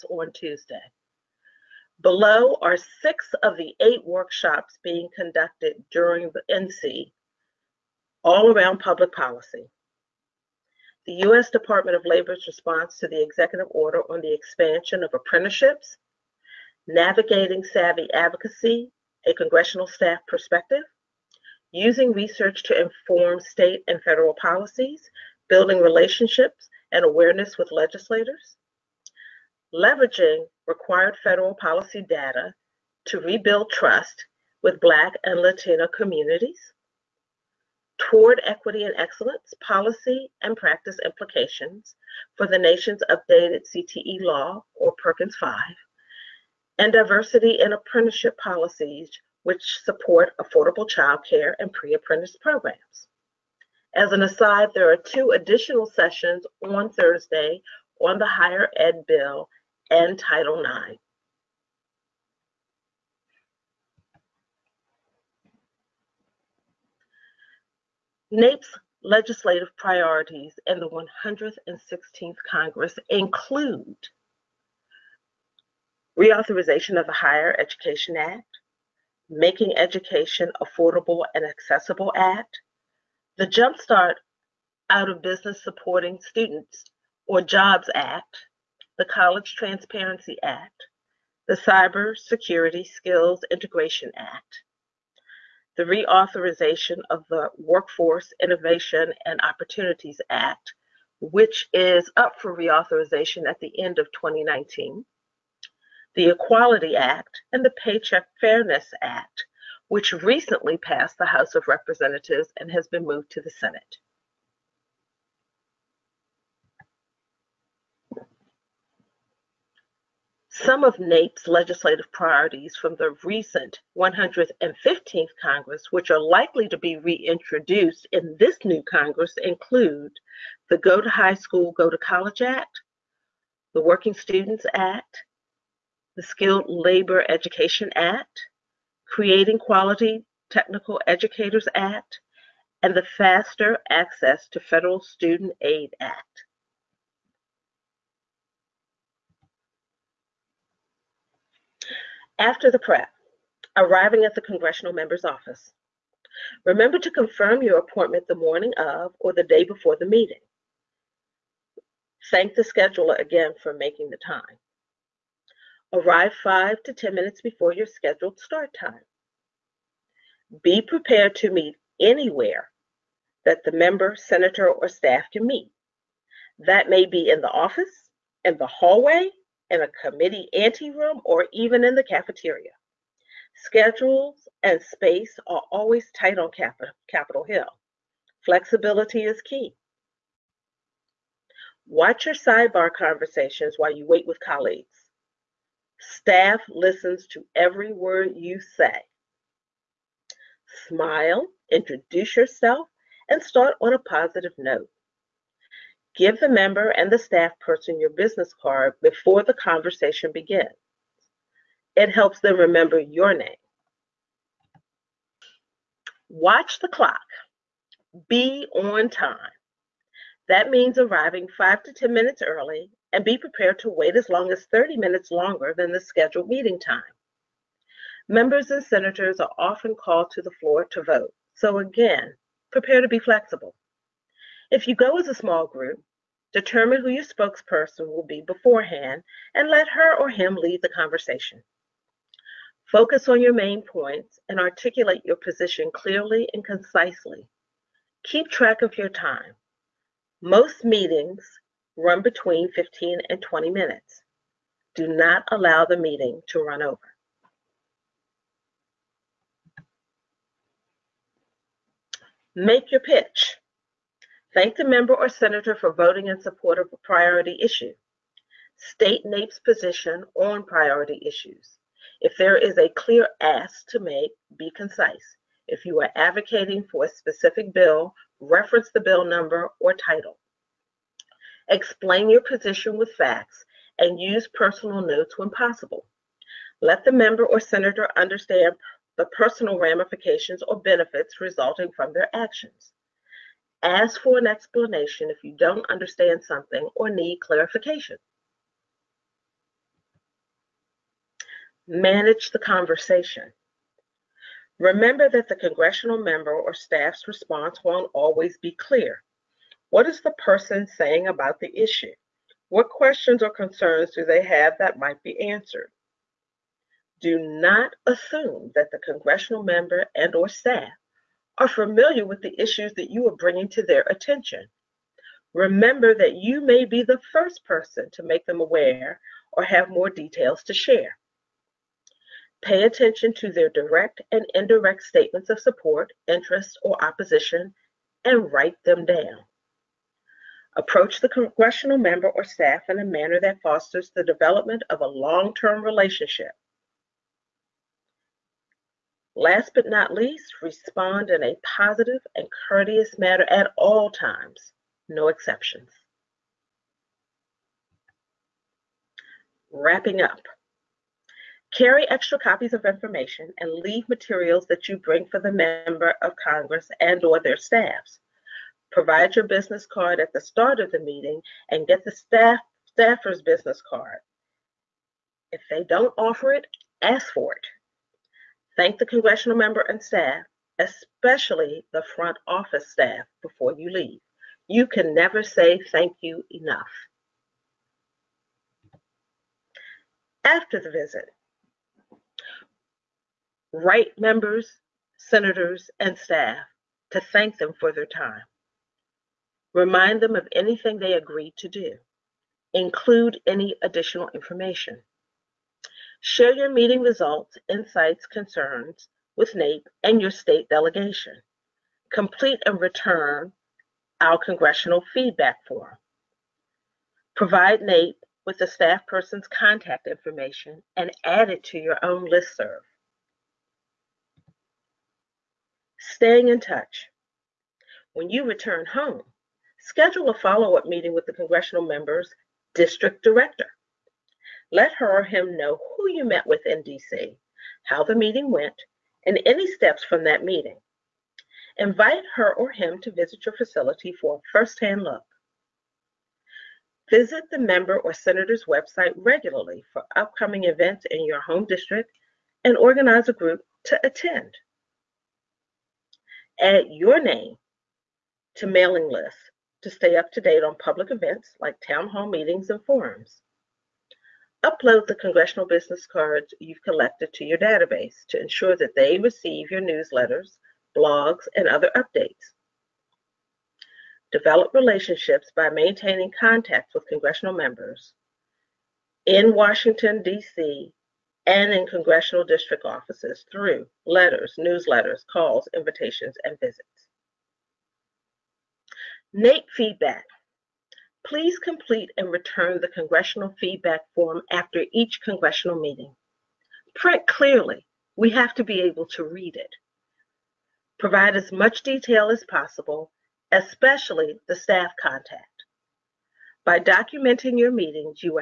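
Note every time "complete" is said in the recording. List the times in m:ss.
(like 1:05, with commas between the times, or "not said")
6:52, 8:11.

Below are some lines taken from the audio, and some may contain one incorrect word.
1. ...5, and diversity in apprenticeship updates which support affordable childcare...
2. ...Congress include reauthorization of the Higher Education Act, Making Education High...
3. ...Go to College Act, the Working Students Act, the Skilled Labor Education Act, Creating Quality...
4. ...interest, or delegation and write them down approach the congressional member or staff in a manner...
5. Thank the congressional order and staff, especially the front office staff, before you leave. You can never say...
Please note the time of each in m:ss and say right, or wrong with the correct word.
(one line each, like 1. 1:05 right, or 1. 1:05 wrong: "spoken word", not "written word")
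1. 0:45 wrong: "policies", not "updates"
2. 1:12 wrong: "Affordable", not "High"
3. 2:11 right
4. 5:36 wrong: "opposition", not "delegation"
5. 6:18 wrong: "member", not "order".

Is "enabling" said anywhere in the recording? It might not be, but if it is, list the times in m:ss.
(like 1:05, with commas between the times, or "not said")
not said.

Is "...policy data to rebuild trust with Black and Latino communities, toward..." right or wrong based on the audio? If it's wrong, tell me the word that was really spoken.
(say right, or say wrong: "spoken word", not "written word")
right.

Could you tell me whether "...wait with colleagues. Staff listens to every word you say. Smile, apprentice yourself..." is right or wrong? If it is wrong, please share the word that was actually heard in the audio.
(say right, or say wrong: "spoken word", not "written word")
wrong: "introduce", not "apprentice".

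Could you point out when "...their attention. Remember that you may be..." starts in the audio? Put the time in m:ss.
5:23.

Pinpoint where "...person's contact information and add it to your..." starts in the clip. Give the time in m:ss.
6:59.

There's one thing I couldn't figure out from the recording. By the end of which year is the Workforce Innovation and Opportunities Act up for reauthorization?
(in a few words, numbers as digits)
2019.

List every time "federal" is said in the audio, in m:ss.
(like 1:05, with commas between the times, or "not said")
0:24, 0:31, 2:24.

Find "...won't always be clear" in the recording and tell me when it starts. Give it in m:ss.
5:07.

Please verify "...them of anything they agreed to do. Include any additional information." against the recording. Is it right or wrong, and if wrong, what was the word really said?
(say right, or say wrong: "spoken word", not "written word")
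right.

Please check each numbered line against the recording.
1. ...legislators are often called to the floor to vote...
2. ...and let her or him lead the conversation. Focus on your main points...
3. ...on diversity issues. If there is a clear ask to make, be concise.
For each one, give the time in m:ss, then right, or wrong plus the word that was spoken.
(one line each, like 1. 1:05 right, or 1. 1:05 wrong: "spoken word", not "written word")
1. 3:48 wrong: "senators", not "legislators"
2. 3:59 right
3. 4:30 wrong: "priority", not "diversity".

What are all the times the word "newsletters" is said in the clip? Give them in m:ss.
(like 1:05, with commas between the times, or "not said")
7:49, 8:04.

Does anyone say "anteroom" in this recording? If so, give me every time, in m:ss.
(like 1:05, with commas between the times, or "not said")
3:00.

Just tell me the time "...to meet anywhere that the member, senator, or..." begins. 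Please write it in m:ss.
2:51.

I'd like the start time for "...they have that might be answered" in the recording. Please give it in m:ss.
5:14.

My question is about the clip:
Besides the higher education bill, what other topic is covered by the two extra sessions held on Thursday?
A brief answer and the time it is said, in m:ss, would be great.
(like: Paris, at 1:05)
Title IX, at 1:00.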